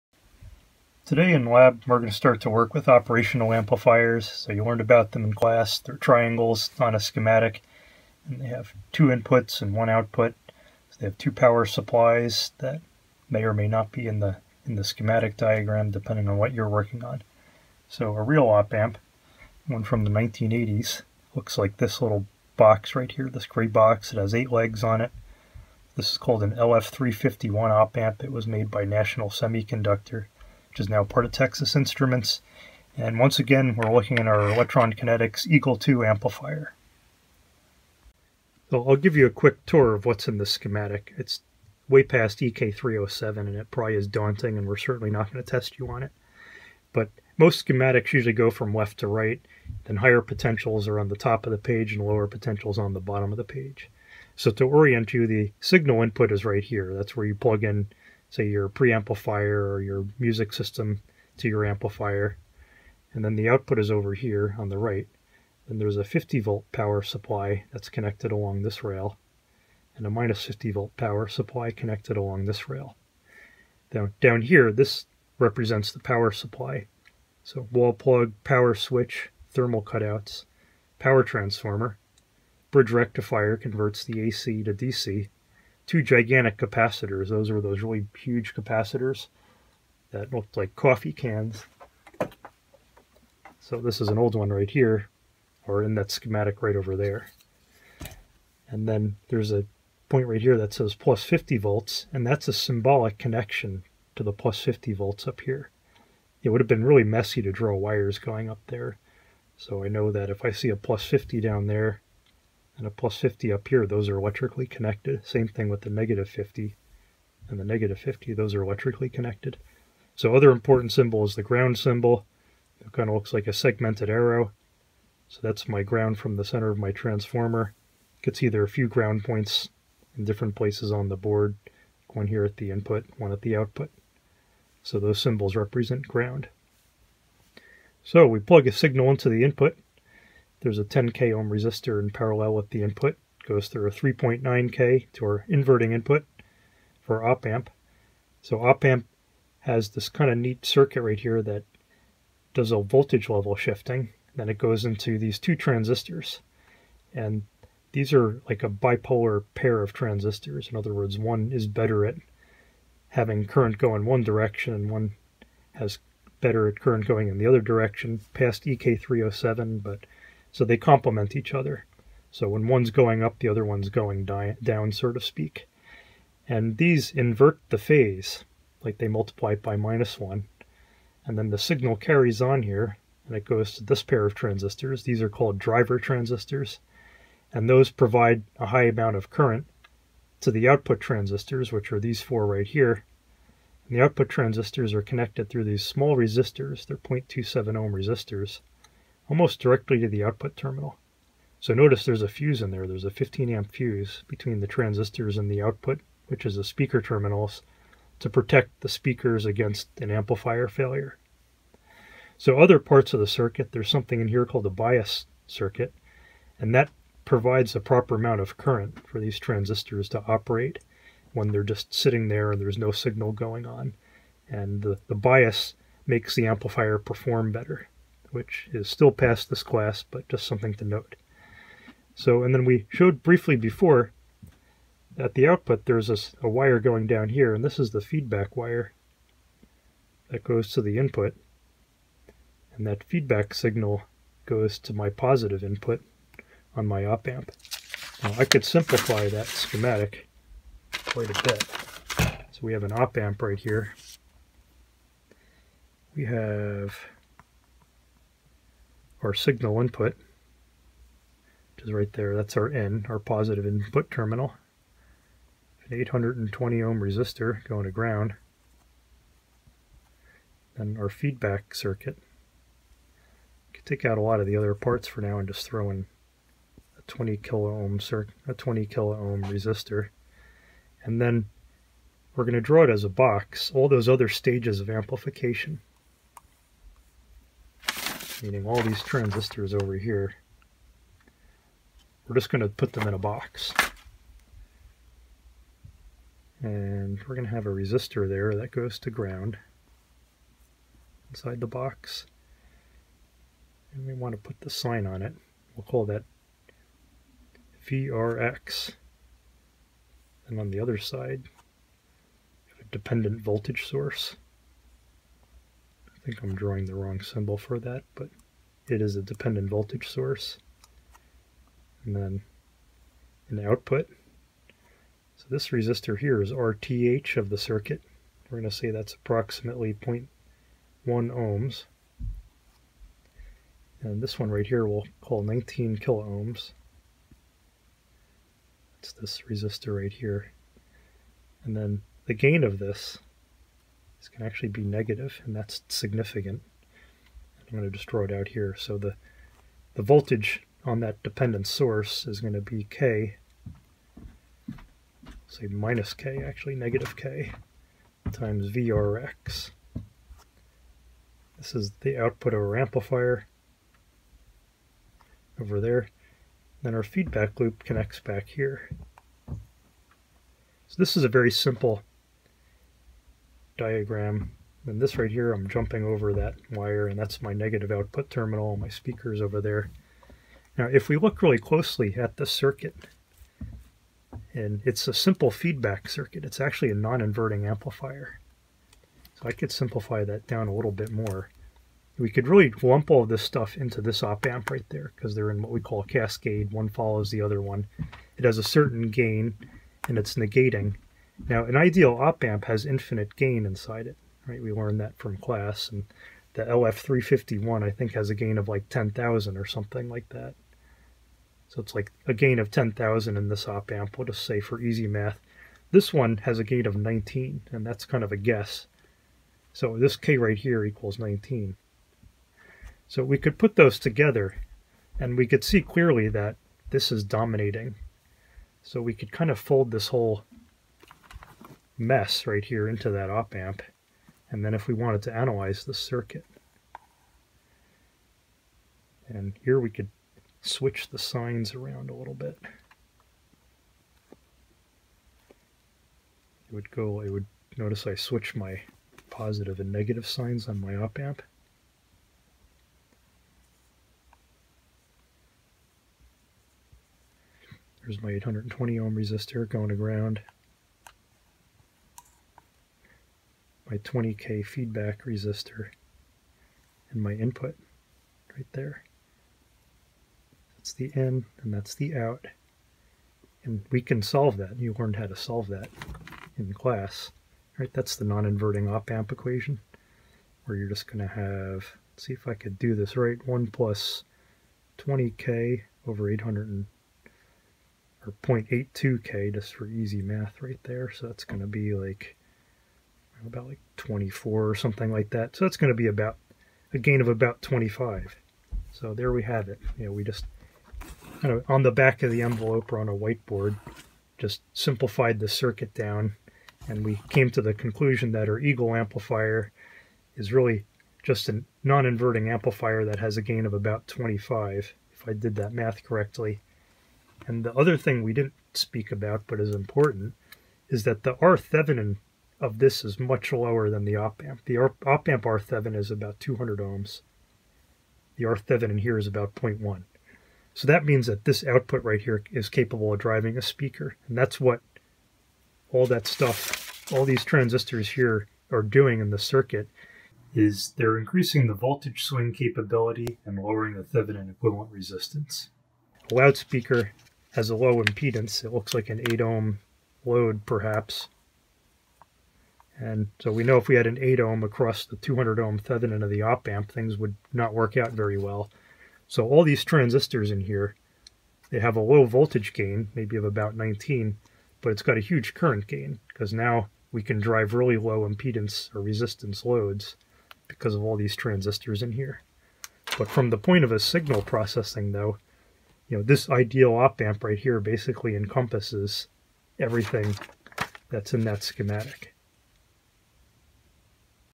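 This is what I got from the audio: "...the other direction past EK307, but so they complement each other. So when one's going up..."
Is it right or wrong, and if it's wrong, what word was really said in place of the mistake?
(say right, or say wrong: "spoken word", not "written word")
right.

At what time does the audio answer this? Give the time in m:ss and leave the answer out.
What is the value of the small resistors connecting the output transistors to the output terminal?
3:16.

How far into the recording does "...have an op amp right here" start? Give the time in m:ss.
4:12.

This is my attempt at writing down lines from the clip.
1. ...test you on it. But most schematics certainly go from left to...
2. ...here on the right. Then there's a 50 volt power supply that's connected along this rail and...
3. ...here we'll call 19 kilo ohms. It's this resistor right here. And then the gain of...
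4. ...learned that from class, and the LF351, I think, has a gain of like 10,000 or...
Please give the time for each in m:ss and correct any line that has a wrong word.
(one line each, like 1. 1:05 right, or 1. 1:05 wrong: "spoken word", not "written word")
1. 0:45 wrong: "usually", not "certainly"
2. 1:04 right
3. 5:34 right
4. 6:44 right.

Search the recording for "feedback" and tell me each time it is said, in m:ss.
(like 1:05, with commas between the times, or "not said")
3:58, 4:03, 4:31, 6:07, 6:25, 7:44.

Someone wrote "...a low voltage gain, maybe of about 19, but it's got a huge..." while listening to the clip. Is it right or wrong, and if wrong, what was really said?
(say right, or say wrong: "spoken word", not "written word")
right.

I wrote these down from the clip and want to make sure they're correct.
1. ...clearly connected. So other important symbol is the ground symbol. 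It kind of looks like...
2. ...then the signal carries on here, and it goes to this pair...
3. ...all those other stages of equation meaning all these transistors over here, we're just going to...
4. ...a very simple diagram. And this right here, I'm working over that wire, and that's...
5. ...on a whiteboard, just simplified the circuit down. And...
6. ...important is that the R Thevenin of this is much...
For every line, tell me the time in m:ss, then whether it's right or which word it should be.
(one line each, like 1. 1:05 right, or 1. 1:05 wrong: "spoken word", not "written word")
1. 1:58 wrong: "electrically", not "clearly"
2. 3:01 right
3. 4:43 wrong: "amplification", not "equation"
4. 6:11 wrong: "jumping", not "working"
5. 8:22 right
6. 8:39 right.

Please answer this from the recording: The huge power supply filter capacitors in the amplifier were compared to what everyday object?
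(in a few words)
coffee cans.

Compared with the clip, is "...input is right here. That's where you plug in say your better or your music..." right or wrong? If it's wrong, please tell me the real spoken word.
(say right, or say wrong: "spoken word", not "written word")
wrong: "preamplifier", not "better".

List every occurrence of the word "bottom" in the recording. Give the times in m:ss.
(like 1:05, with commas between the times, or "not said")
0:53.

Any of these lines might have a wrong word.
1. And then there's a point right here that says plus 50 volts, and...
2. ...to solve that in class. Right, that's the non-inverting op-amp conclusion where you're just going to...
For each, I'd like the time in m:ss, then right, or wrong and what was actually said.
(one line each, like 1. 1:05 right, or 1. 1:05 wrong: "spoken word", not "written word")
1. 1:38 right
2. 7:55 wrong: "equation", not "conclusion".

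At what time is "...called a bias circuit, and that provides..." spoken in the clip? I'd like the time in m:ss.
3:34.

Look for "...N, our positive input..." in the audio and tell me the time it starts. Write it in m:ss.
4:22.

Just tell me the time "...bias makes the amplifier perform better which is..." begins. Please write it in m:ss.
3:45.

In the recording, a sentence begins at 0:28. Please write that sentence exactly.
It was made by National Semiconductor which is now part of Texas Instruments.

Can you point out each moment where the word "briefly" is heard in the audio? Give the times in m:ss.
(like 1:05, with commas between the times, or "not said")
3:53.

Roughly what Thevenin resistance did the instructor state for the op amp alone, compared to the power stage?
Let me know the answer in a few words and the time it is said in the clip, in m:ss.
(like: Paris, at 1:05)
200 ohms, at 8:46.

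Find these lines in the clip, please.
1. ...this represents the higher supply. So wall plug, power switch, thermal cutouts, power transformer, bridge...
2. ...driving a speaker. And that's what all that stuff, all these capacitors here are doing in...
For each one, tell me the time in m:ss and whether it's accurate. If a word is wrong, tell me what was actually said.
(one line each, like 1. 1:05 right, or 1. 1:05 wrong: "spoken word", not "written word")
1. 1:14 wrong: "power", not "higher"
2. 8:53 wrong: "transistors", not "capacitors".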